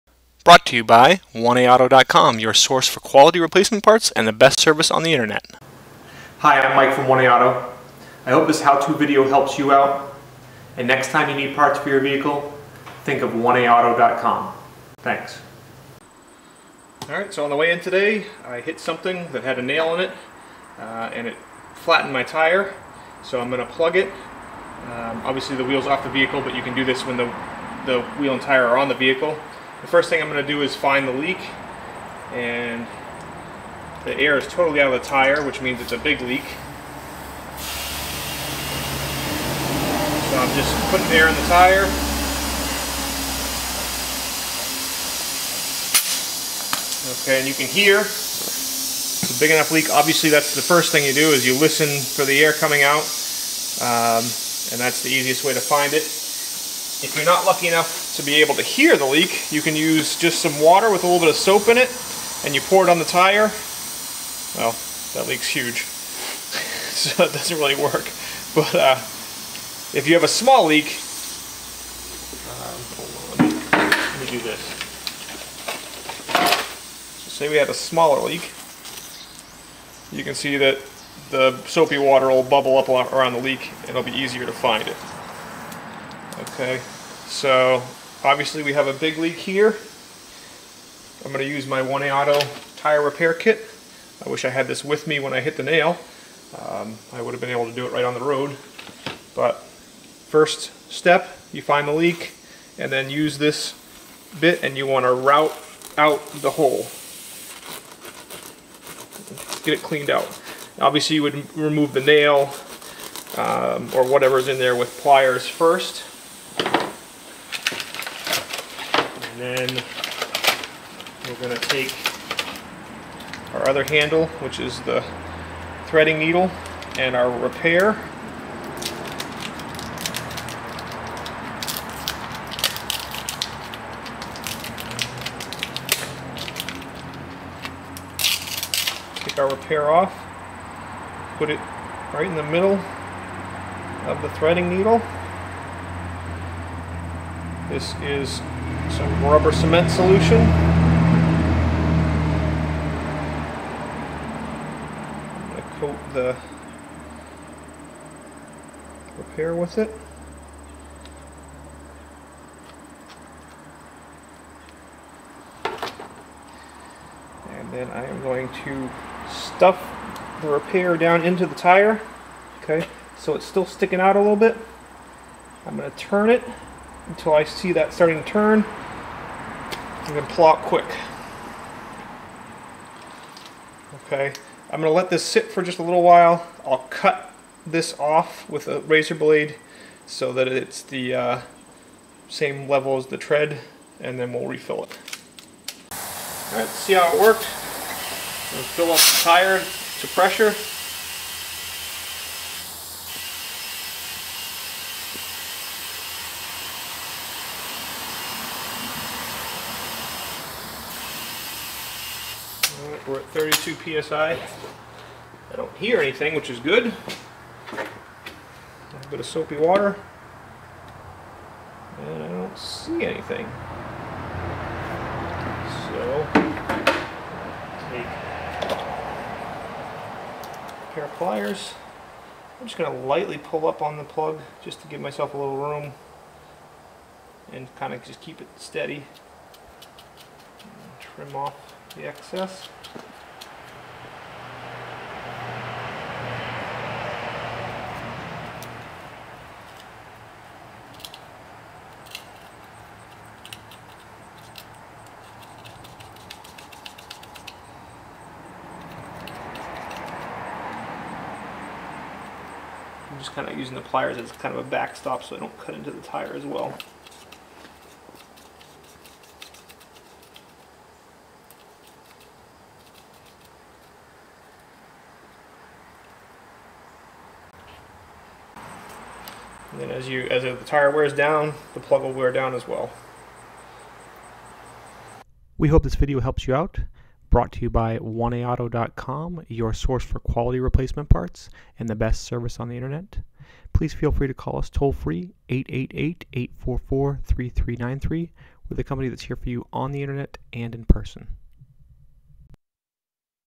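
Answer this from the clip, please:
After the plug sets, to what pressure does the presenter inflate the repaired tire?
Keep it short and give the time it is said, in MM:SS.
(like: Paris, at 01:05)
32 psi, at 03:33.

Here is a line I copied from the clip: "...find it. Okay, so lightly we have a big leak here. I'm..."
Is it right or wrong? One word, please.
wrong.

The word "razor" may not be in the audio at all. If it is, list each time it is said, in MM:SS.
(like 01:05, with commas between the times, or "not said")
03:08.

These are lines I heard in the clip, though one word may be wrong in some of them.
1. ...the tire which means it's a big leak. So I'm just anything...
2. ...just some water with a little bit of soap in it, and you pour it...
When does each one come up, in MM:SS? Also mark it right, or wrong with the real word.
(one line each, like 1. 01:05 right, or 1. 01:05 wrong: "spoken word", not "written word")
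1. 00:35 wrong: "putting", not "anything"
2. 01:00 right.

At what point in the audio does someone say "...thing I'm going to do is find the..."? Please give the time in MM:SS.
00:30.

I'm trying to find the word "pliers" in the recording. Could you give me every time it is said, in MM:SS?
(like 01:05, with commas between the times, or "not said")
01:55, 03:51, 04:23.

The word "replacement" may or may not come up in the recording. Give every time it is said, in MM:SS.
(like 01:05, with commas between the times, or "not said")
00:03, 04:50.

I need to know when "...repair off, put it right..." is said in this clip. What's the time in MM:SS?
02:19.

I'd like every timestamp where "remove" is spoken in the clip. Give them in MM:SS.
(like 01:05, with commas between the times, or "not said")
01:51.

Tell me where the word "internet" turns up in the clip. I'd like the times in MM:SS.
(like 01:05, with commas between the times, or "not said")
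00:05, 04:52, 05:00.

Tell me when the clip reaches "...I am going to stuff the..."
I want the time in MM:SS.
02:47.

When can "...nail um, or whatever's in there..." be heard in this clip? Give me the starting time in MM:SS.
01:52.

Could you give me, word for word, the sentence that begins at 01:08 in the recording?
But uh, if you have a small leak, um, let me do this.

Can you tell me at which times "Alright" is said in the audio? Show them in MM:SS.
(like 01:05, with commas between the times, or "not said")
00:17, 03:16.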